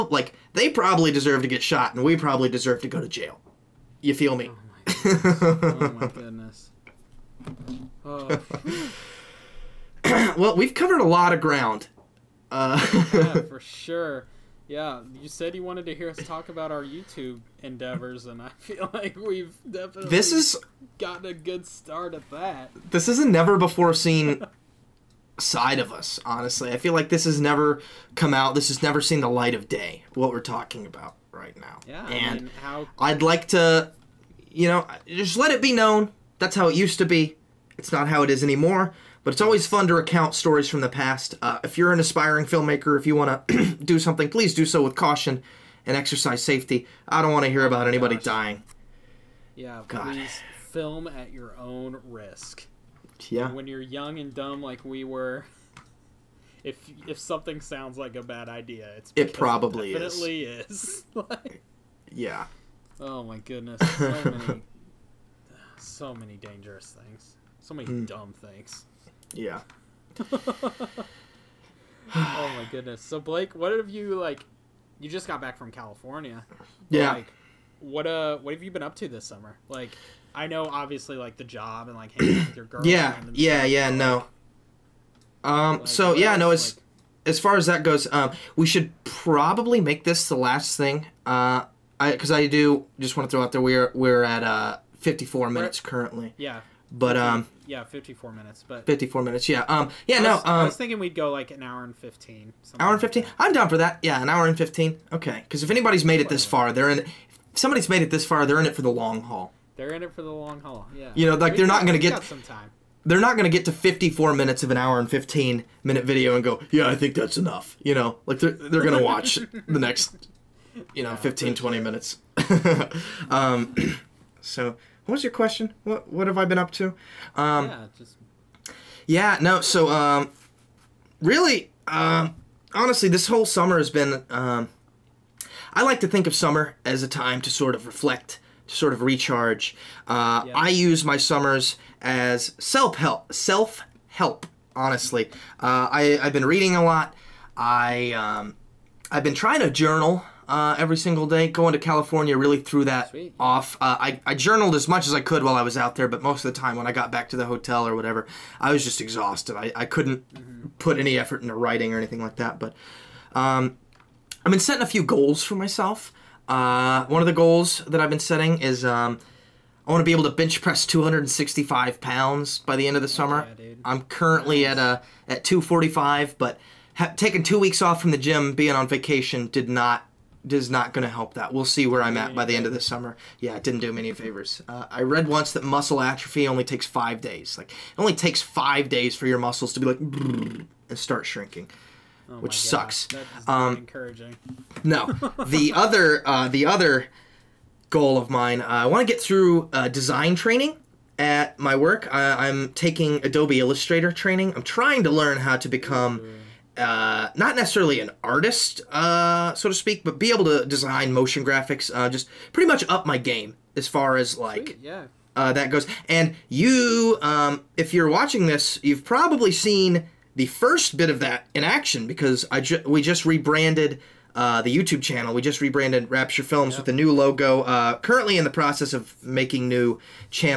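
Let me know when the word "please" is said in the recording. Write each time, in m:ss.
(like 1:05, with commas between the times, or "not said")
0:44, 0:50.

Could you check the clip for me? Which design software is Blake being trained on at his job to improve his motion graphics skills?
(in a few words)
Adobe Illustrator.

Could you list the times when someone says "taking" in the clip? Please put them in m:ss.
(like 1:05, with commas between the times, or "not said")
2:57, 3:22.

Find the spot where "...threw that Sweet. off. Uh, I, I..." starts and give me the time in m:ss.
2:32.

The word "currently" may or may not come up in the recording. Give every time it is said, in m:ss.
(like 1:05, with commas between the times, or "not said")
1:35, 2:54, 3:47.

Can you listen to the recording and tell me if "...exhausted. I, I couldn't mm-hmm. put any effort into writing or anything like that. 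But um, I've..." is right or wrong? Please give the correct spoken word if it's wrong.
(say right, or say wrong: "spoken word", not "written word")
right.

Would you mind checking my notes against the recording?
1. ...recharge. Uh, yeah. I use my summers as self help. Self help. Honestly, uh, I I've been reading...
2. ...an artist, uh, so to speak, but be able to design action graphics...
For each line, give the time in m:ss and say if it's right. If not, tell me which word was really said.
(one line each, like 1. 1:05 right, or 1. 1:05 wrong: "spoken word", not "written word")
1. 2:19 right
2. 3:28 wrong: "motion", not "action".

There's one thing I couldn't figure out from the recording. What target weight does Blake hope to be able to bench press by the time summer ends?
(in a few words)
265 pounds.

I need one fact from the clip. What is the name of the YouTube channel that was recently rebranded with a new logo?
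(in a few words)
Rapture Films.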